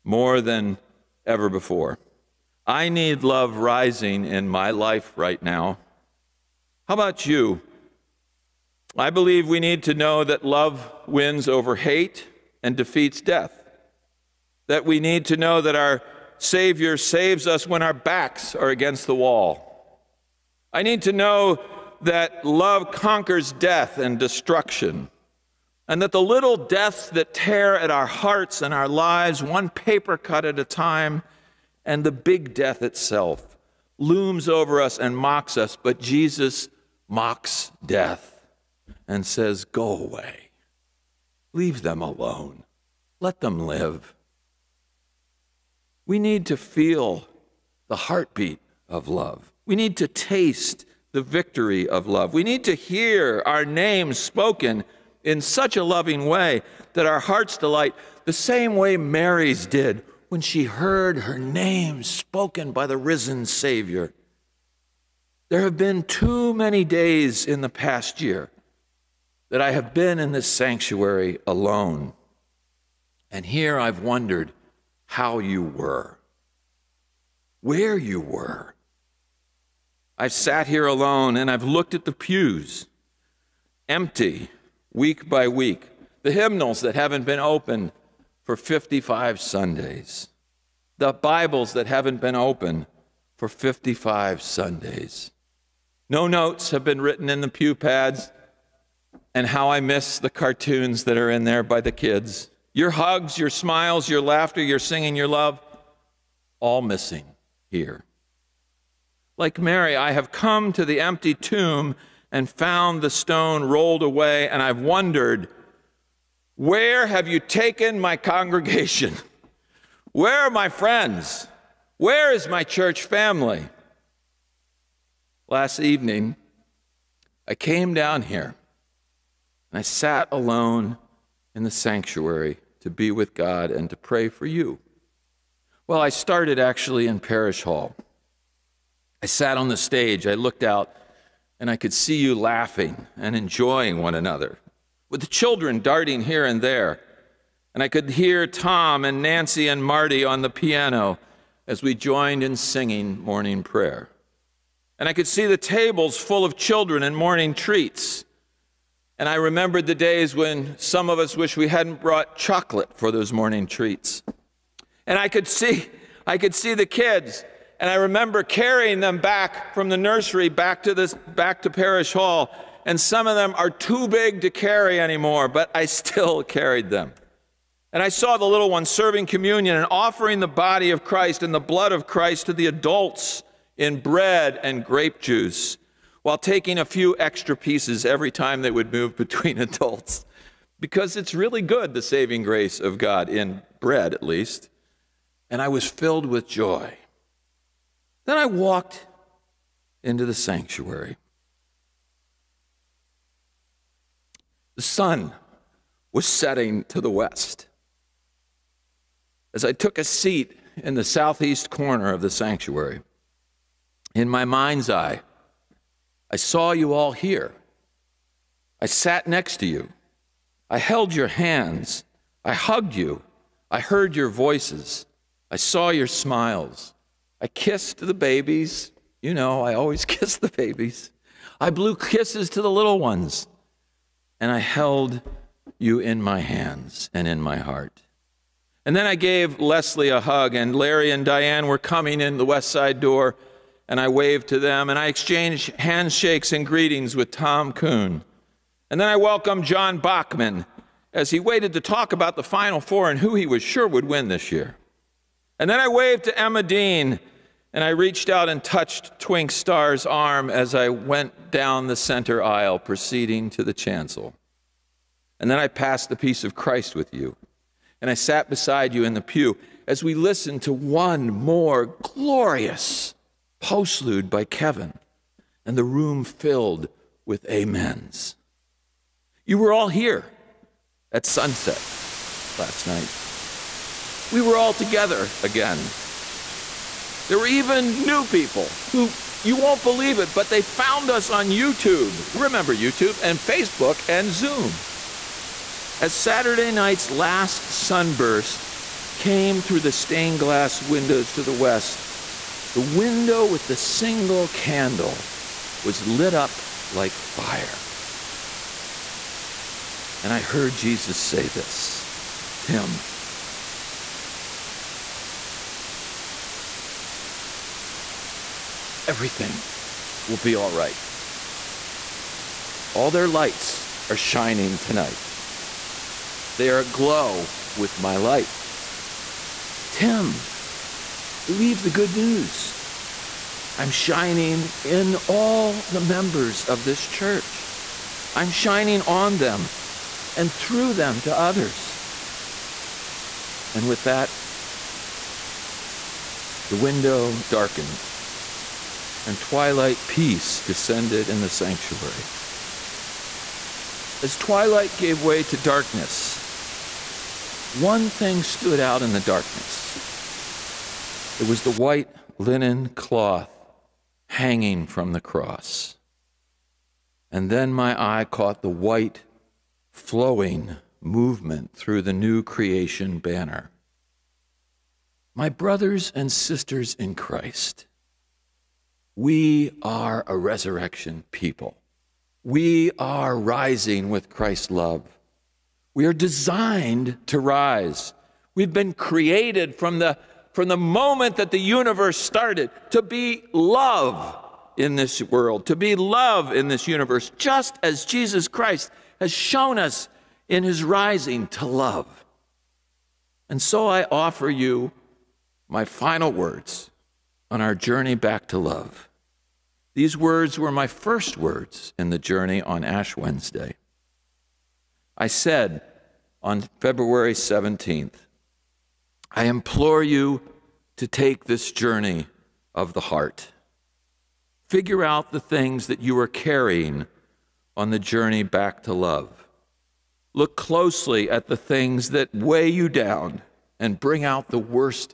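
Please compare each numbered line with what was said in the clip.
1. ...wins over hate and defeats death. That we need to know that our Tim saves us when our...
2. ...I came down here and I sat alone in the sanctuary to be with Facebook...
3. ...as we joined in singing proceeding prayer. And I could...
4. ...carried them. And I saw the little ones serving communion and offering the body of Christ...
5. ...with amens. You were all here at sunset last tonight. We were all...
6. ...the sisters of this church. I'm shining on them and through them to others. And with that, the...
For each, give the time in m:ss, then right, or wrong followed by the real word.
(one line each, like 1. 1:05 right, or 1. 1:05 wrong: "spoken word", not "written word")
1. 0:11 wrong: "Savior", not "Tim"
2. 2:07 wrong: "God", not "Facebook"
3. 2:31 wrong: "morning", not "proceeding"
4. 2:56 right
5. 4:37 wrong: "night", not "tonight"
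6. 5:35 wrong: "members", not "sisters".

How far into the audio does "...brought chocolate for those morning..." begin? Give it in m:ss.
2:42.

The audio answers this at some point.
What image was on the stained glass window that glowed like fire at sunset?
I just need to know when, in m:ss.
5:03.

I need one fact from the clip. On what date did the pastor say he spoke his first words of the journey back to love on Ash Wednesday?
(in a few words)
February 17.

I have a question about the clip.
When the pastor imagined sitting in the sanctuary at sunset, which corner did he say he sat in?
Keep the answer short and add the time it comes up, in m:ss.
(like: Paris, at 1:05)
Southeast corner, at 3:31.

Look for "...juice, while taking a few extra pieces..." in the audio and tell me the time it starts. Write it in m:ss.
3:05.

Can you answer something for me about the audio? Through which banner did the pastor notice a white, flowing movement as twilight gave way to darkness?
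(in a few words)
New creation banner.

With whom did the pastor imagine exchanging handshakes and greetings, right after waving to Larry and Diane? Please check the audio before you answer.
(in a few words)
Tom Kuhn.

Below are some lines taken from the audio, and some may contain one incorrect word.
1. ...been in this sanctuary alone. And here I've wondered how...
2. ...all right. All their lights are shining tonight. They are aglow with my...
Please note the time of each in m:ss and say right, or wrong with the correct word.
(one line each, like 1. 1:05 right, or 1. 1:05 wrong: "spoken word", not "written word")
1. 1:09 right
2. 5:20 right.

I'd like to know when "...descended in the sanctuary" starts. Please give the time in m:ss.
5:50.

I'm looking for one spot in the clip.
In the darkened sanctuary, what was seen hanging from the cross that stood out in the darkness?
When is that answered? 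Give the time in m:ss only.
6:01.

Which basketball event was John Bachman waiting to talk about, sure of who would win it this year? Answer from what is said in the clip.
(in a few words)
Final Four.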